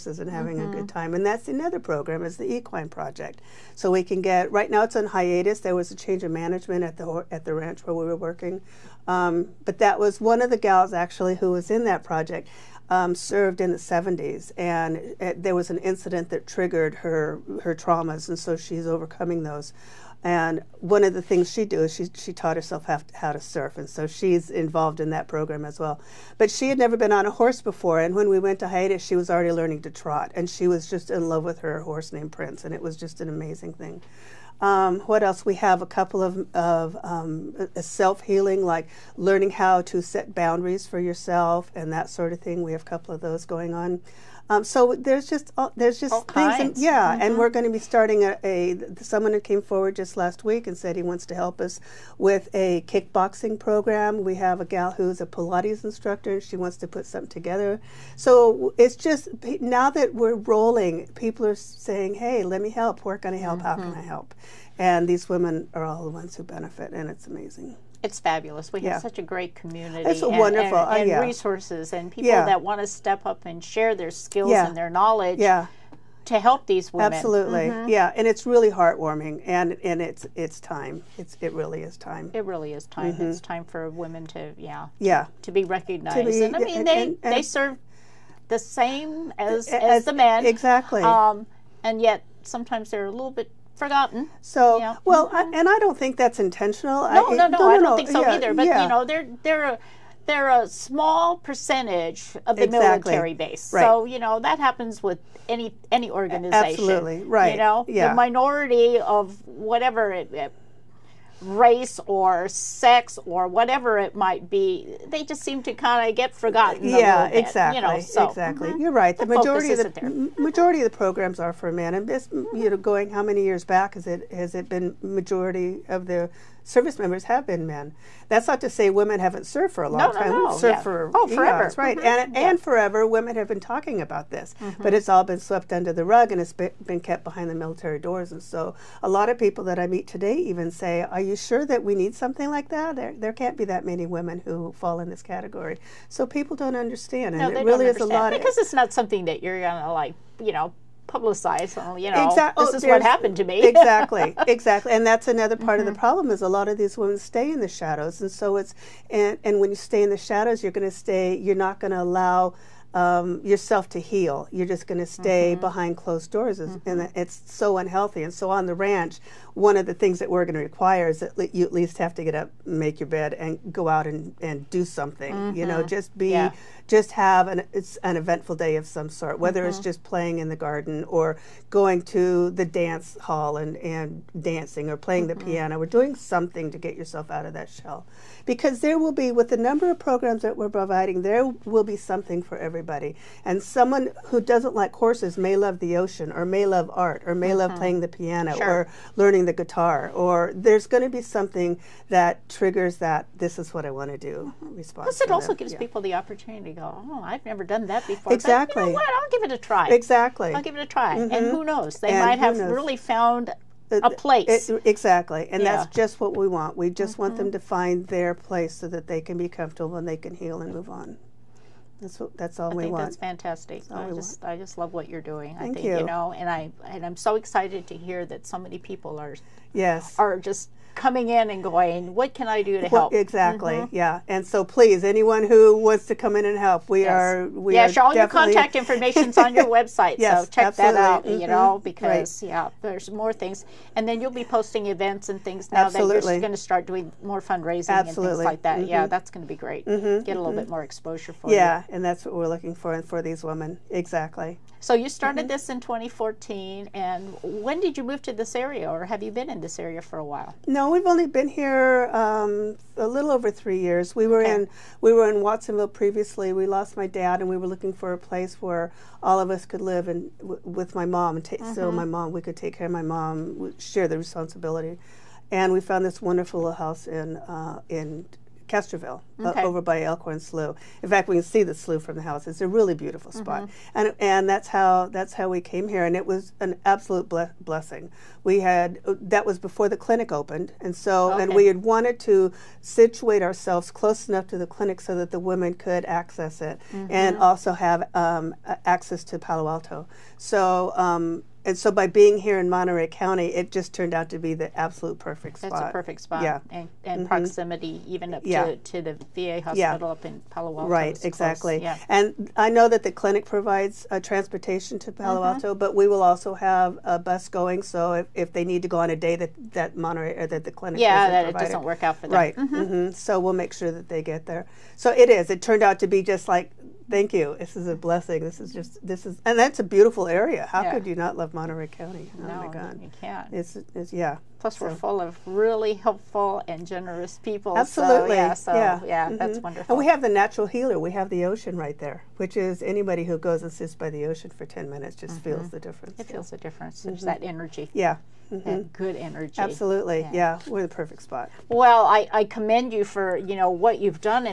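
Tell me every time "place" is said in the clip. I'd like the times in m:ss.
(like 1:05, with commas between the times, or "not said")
3:34, 3:38, 4:28.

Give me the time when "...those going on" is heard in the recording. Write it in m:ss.
0:43.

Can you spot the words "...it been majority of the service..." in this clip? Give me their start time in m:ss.
2:04.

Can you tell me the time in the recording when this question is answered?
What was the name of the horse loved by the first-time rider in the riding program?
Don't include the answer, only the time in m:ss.
0:32.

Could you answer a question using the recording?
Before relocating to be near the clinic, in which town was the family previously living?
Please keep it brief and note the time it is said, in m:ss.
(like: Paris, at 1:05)
Watsonville, at 4:25.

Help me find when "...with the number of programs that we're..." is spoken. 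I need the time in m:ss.
3:09.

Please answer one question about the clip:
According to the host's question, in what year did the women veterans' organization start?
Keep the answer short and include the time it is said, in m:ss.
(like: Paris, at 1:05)
2014, at 4:15.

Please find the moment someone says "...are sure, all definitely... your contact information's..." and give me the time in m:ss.
3:57.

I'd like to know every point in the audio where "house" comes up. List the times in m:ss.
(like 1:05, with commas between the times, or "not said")
4:36, 4:42.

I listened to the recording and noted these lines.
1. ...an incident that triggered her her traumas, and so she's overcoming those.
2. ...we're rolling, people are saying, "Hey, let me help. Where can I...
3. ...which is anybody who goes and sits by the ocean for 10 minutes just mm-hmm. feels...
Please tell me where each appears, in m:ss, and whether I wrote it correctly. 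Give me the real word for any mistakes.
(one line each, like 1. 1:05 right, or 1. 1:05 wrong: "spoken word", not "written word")
1. 0:15 right
2. 1:00 right
3. 5:42 right.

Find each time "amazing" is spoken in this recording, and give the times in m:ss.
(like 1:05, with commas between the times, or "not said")
0:33, 1:07.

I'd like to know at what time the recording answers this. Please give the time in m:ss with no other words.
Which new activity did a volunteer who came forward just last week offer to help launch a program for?
0:52.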